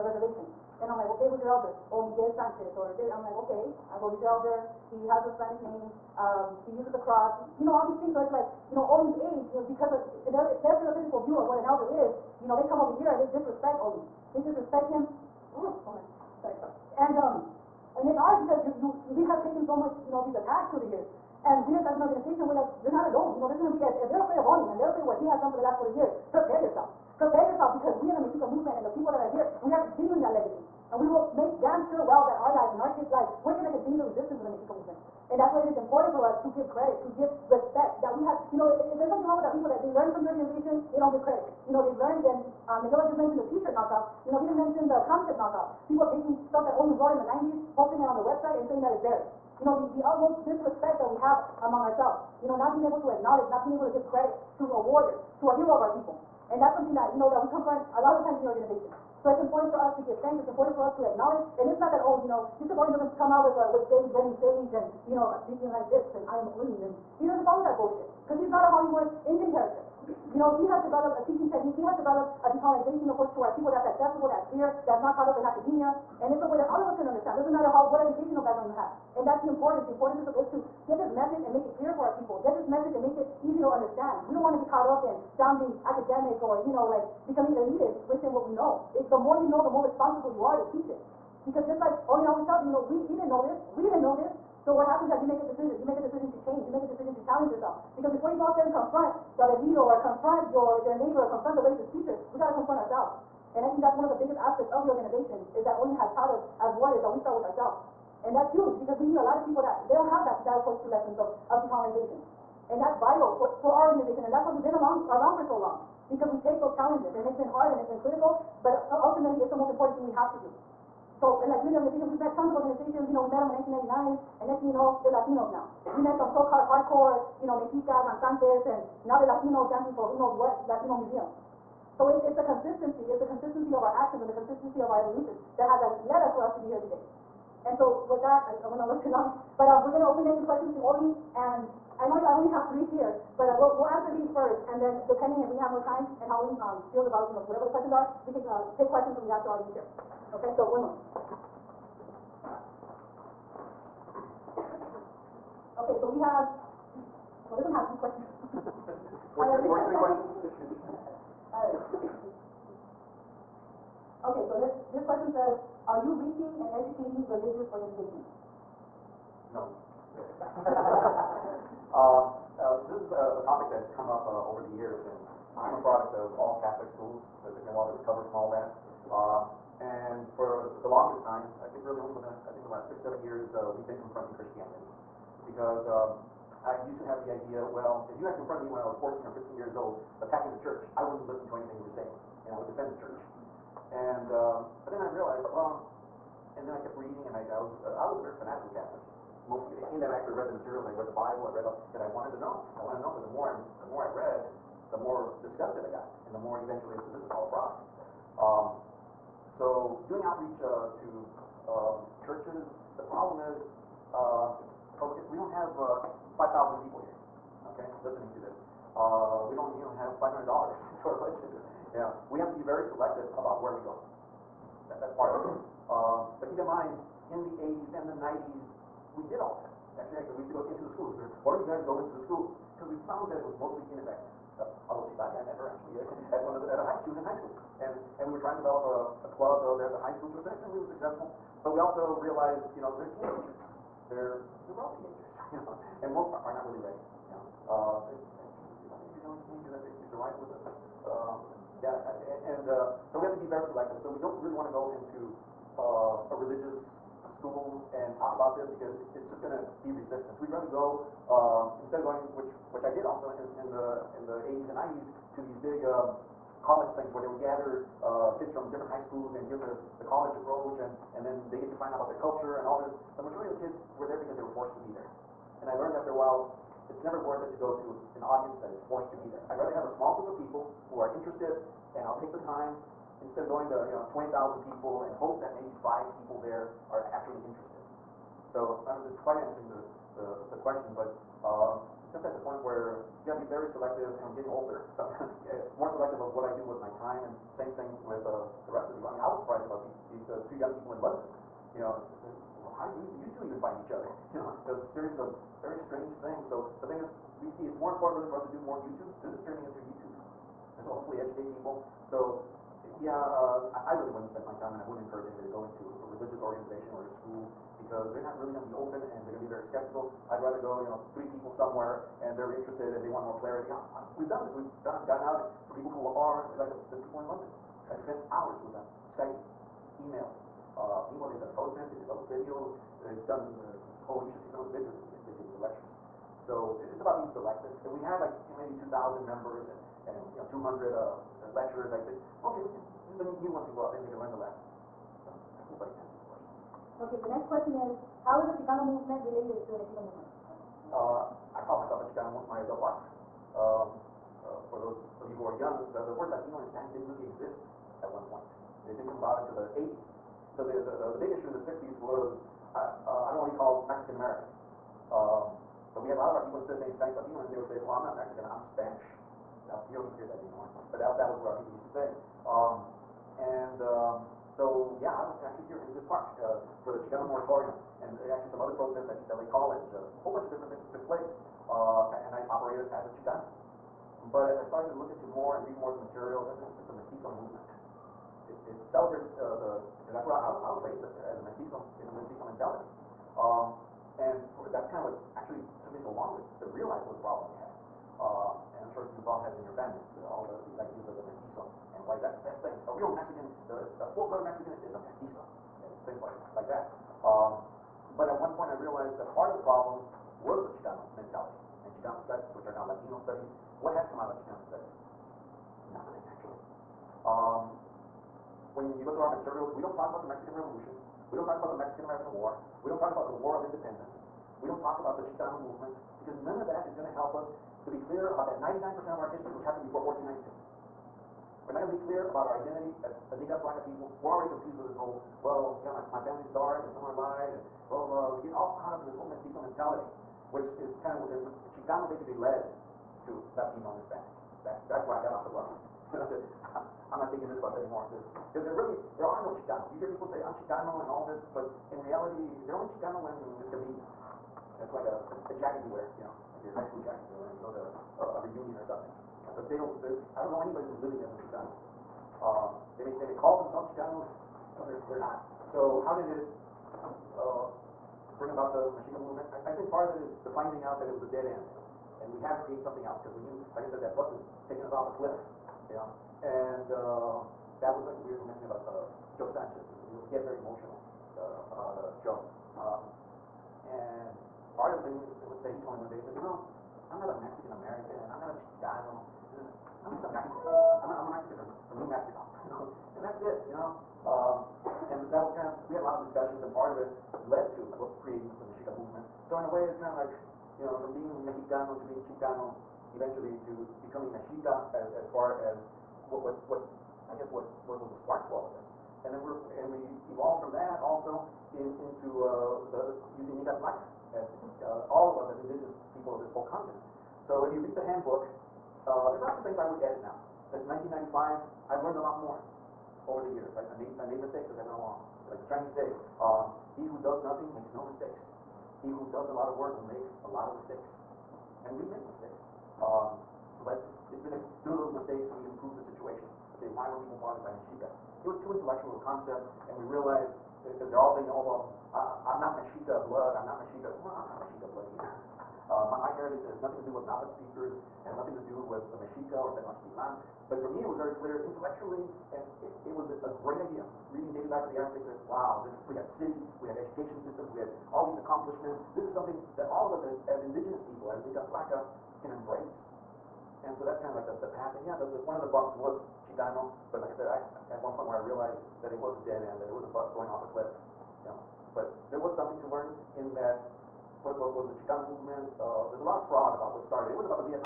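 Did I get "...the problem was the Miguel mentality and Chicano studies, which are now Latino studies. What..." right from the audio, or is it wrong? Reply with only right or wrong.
wrong.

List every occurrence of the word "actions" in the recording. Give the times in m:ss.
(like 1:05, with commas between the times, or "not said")
2:13.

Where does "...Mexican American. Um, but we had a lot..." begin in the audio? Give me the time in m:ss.
6:03.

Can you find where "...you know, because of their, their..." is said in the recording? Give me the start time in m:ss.
0:09.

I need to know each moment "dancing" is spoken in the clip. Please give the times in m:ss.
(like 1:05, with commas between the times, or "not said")
2:09.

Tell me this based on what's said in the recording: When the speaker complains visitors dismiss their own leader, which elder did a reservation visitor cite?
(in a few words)
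Miguel Sanchez.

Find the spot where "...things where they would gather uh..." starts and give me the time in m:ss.
4:26.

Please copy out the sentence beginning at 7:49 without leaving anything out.
I, I think part of it is the finding out that it was a dead end.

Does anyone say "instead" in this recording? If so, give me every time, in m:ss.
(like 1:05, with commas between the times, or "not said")
4:21, 4:43, 6:06.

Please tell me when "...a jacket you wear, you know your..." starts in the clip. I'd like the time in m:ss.
7:35.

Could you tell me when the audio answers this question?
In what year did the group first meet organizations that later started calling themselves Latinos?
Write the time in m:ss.
2:03.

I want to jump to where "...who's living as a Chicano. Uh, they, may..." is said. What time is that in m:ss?
7:40.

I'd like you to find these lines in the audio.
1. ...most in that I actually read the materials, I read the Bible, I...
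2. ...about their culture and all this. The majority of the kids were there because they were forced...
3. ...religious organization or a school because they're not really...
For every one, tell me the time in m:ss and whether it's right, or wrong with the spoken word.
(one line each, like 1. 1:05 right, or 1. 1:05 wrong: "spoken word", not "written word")
1. 3:19 right
2. 4:31 right
3. 5:16 right.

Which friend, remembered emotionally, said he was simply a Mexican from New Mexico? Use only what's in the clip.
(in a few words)
Joe Sanchez.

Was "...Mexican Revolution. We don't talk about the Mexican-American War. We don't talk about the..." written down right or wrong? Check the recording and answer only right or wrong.
right.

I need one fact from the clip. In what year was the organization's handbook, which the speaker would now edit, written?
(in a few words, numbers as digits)
1995.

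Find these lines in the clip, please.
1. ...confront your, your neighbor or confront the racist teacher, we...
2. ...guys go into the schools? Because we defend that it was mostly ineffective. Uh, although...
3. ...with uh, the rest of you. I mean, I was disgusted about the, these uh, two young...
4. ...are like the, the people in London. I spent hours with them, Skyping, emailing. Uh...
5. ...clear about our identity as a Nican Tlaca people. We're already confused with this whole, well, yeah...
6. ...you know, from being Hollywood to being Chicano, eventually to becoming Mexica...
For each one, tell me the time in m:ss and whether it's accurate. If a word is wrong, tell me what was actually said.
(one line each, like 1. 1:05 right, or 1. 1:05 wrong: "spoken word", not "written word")
1. 1:40 right
2. 3:51 wrong: "found", not "defend"
3. 4:58 wrong: "surprised", not "disgusted"
4. 5:26 right
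5. 7:12 right
6. 8:20 wrong: "Mexicano", not "Hollywood".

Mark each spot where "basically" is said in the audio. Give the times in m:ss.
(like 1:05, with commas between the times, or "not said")
4:09, 7:22.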